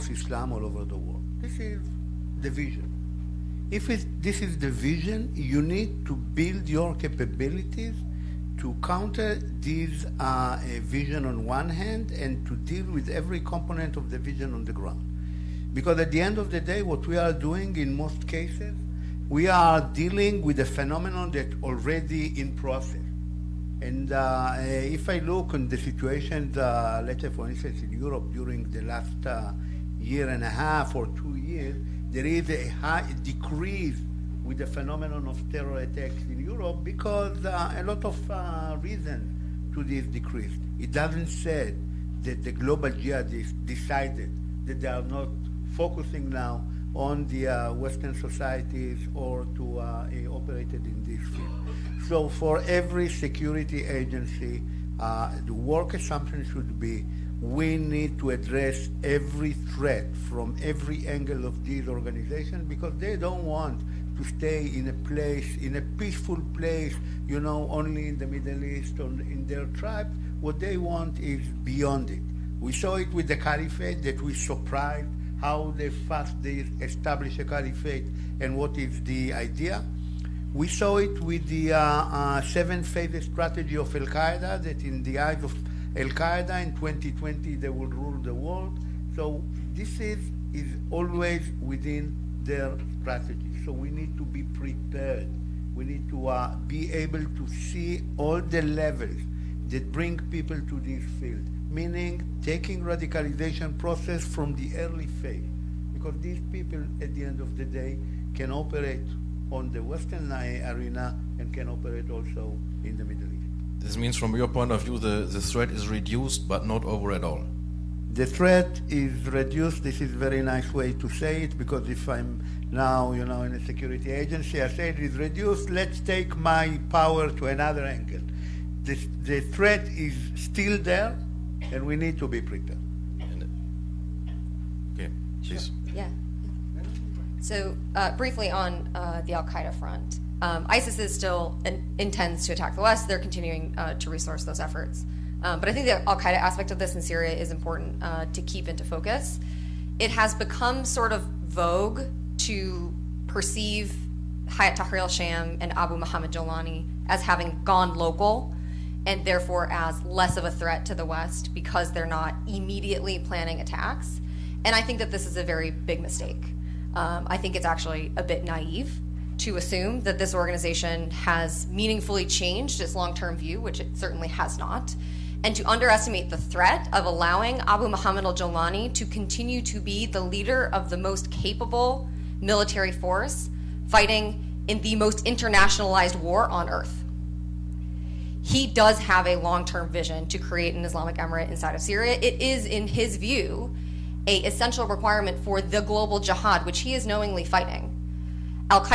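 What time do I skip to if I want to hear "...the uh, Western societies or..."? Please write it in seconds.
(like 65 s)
47 s.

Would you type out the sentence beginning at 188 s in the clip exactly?
He does have a long term vision to create an Islamic emirate inside of Syria.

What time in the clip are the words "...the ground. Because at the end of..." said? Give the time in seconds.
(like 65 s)
14 s.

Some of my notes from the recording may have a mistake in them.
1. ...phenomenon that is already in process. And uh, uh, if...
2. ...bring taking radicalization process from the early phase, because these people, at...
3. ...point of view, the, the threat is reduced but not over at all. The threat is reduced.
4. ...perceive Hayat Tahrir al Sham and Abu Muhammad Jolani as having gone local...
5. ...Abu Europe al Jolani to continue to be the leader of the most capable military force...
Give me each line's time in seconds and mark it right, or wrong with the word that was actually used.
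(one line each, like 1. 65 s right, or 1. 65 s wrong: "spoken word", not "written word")
1. 20 s right
2. 101 s wrong: "meaning", not "bring"
3. 114 s right
4. 153 s right
5. 177 s wrong: "Muhammad", not "Europe".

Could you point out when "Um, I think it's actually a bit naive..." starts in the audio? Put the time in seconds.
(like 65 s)
166 s.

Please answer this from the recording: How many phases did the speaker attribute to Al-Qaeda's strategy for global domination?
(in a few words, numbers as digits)
7.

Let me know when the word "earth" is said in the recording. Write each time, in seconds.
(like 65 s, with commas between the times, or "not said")
186 s.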